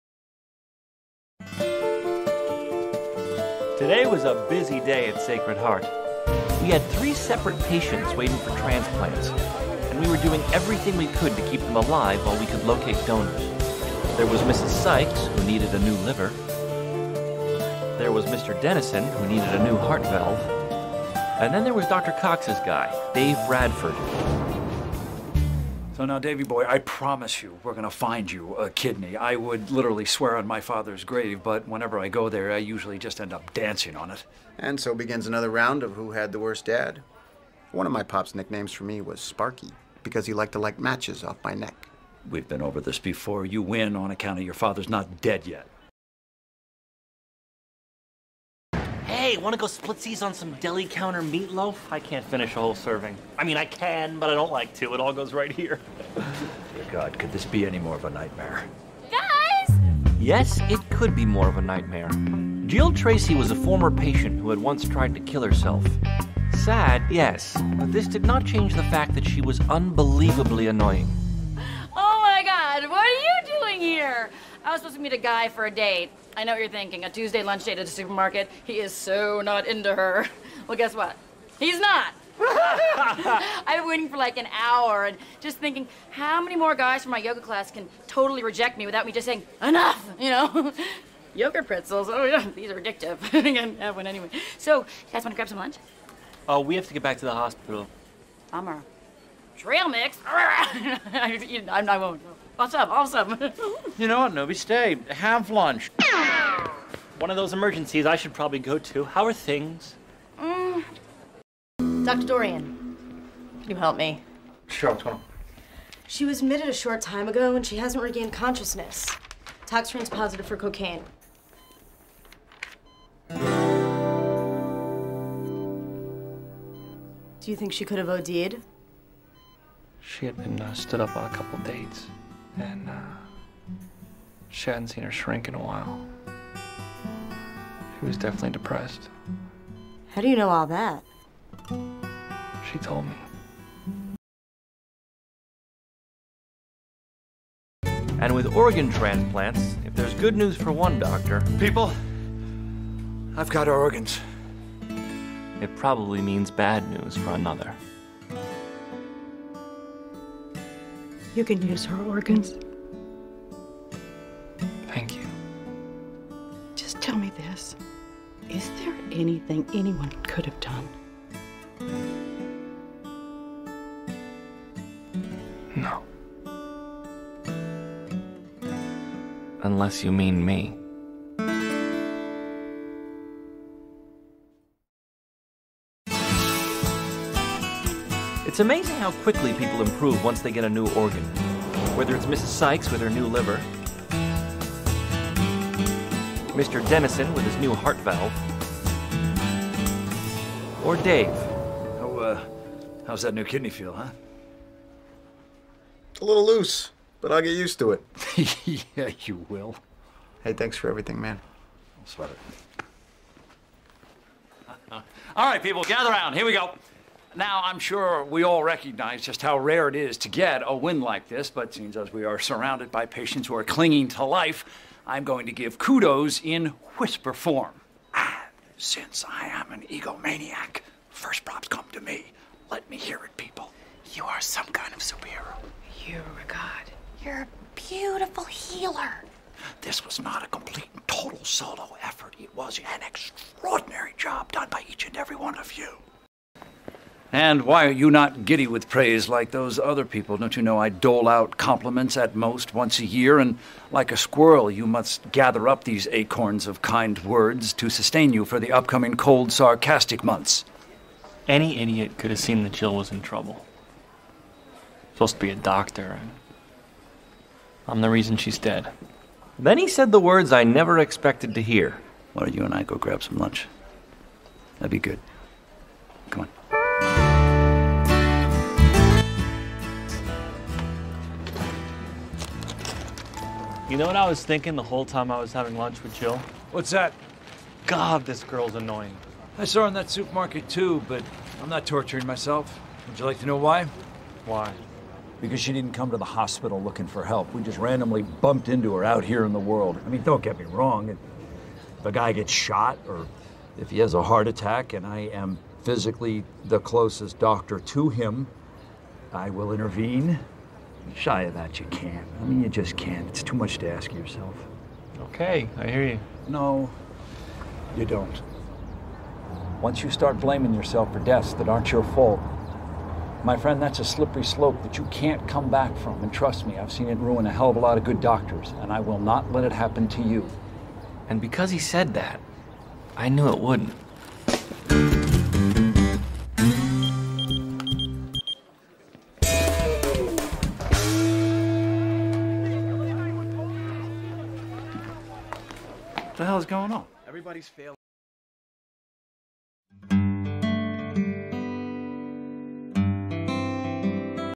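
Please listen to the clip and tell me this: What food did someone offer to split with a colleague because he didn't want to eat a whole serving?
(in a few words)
deli counter meatloaf.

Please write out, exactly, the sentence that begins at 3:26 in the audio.
A little loose, but I'll get used to it.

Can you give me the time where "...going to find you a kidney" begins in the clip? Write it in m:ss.
0:27.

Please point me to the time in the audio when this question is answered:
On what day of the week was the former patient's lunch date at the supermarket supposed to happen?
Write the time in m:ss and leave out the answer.
1:17.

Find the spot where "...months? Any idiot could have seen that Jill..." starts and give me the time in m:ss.
4:20.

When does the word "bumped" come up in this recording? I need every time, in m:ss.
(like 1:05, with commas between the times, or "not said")
4:58.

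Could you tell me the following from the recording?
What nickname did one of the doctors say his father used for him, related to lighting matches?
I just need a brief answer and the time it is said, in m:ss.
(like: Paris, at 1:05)
Sparky, at 0:39.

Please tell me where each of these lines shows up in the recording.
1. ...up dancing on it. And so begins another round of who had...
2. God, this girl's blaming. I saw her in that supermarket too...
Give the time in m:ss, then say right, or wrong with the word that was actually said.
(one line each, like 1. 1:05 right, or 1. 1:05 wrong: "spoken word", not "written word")
1. 0:33 right
2. 4:47 wrong: "annoying", not "blaming".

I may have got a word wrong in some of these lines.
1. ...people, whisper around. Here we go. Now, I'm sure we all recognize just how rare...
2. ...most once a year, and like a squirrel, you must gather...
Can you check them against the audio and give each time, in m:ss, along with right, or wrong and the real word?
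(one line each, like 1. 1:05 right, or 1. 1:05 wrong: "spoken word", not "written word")
1. 3:35 wrong: "gather", not "whisper"
2. 4:12 right.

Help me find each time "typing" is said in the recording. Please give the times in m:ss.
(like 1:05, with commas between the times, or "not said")
not said.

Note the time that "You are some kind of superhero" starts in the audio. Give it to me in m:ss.
3:54.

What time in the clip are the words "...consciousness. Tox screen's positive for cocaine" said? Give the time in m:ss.
1:58.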